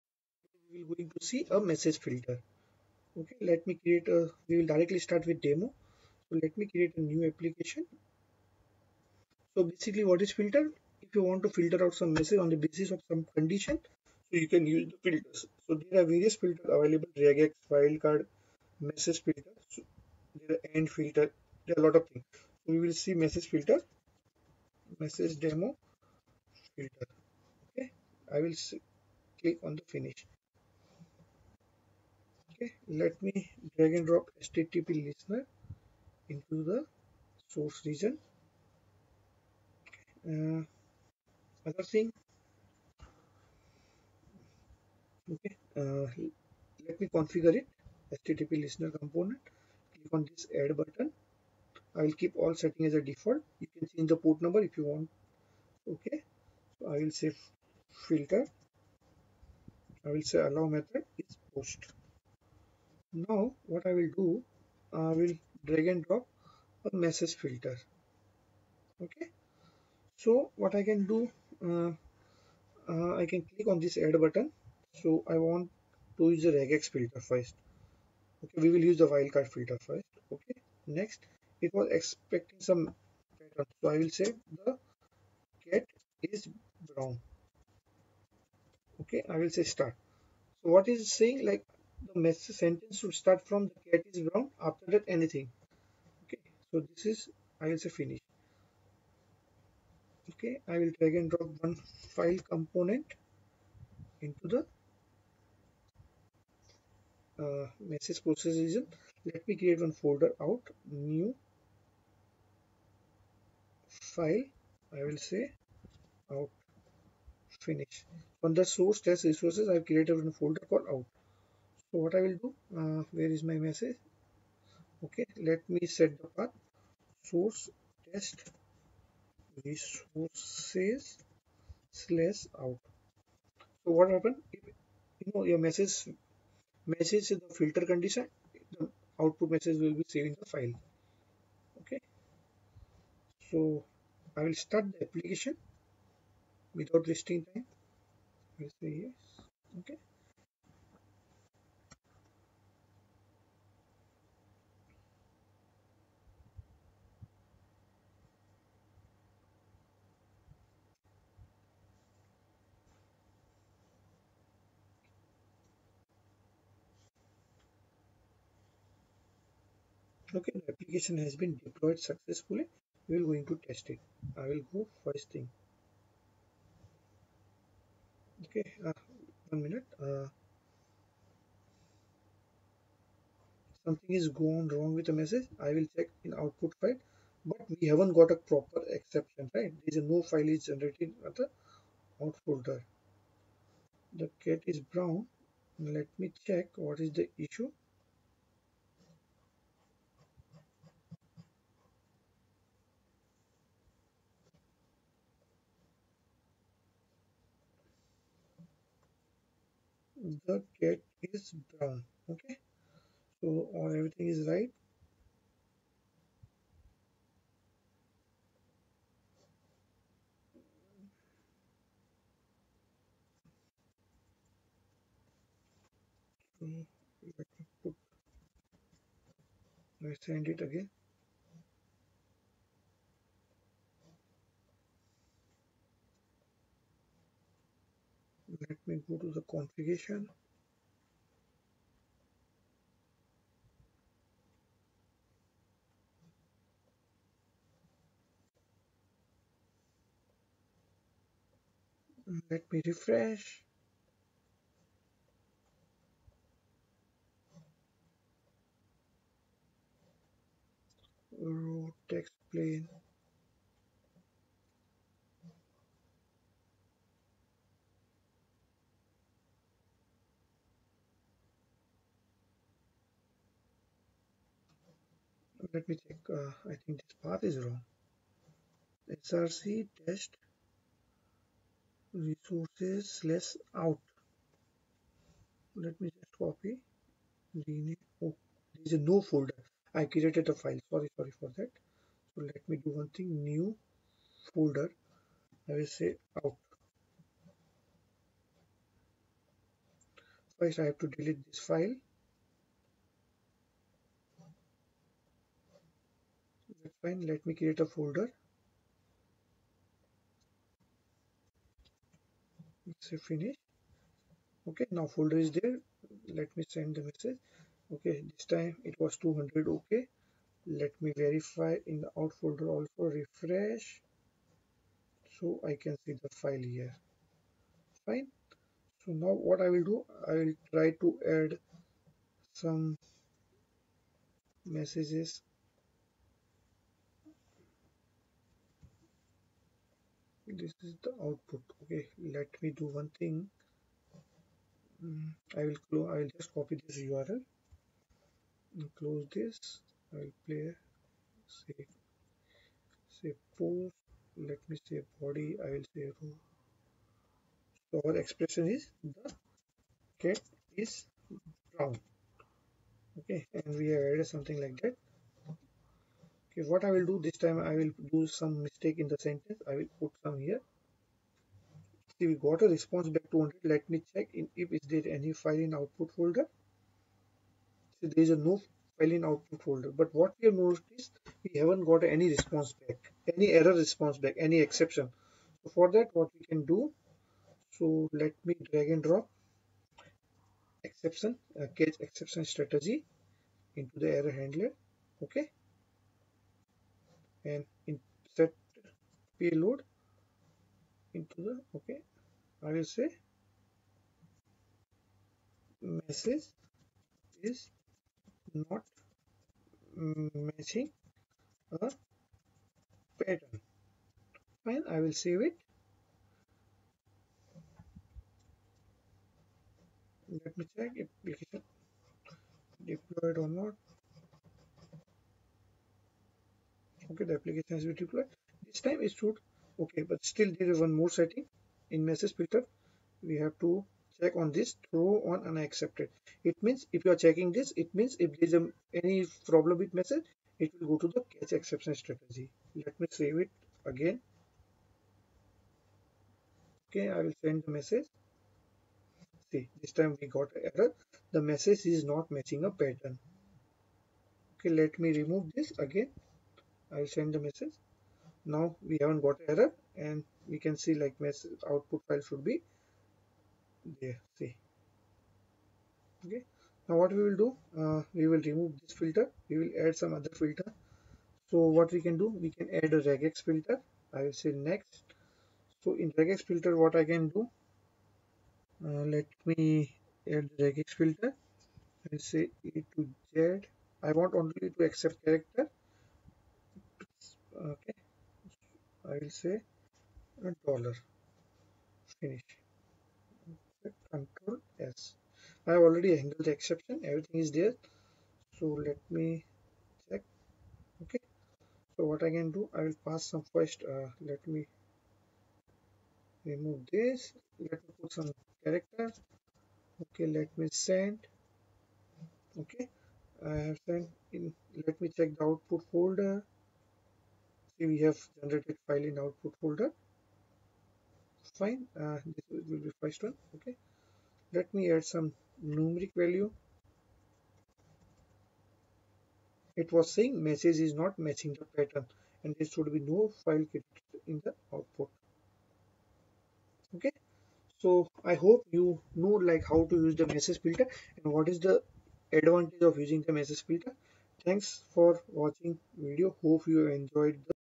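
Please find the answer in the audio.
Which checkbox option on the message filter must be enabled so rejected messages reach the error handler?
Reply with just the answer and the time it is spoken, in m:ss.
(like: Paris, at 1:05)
throw on unaccepted, at 7:14.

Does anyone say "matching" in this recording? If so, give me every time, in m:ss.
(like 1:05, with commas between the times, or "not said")
6:50, 7:32, 8:51.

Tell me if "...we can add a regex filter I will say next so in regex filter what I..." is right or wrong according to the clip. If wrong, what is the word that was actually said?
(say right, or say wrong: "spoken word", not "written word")
right.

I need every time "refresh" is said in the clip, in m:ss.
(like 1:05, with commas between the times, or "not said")
4:12, 5:23.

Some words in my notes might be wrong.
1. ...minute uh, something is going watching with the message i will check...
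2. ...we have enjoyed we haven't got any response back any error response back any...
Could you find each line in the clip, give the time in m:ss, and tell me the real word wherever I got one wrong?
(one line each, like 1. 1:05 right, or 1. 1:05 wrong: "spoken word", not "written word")
1. 2:59 wrong: "wrong", not "watching"
2. 6:20 wrong: "noticed", not "enjoyed".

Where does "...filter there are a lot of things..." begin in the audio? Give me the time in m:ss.
0:20.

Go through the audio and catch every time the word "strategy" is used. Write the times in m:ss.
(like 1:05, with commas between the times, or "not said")
6:32, 7:22.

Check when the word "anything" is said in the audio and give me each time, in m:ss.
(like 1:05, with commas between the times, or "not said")
1:35.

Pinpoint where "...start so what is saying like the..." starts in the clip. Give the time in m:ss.
1:29.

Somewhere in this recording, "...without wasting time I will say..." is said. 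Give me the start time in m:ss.
2:26.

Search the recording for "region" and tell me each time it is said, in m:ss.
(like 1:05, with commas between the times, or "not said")
0:37, 1:48.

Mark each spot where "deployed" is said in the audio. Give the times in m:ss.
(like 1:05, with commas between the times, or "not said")
2:51, 7:02, 7:08.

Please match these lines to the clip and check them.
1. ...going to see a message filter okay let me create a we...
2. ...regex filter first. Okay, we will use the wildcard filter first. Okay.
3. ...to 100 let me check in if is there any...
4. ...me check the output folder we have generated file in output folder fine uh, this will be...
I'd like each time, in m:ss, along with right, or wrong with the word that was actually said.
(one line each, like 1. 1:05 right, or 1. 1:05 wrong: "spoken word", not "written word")
1. 0:00 right
2. 1:16 right
3. 6:13 right
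4. 8:35 right.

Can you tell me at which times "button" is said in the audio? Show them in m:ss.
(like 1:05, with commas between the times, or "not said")
0:50, 1:14.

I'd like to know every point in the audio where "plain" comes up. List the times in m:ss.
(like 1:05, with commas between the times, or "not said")
4:22.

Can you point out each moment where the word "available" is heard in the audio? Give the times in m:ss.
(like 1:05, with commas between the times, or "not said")
0:16.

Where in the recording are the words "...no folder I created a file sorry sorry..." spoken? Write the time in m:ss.
4:49.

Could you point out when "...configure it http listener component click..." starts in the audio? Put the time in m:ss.
0:47.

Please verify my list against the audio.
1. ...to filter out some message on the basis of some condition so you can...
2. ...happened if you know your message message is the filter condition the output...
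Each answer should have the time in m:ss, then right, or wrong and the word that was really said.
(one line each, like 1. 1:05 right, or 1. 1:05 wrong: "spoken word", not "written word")
1. 0:11 right
2. 2:14 right.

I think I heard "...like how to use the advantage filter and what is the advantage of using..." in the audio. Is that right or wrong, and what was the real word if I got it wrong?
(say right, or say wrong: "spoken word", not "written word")
wrong: "message", not "advantage".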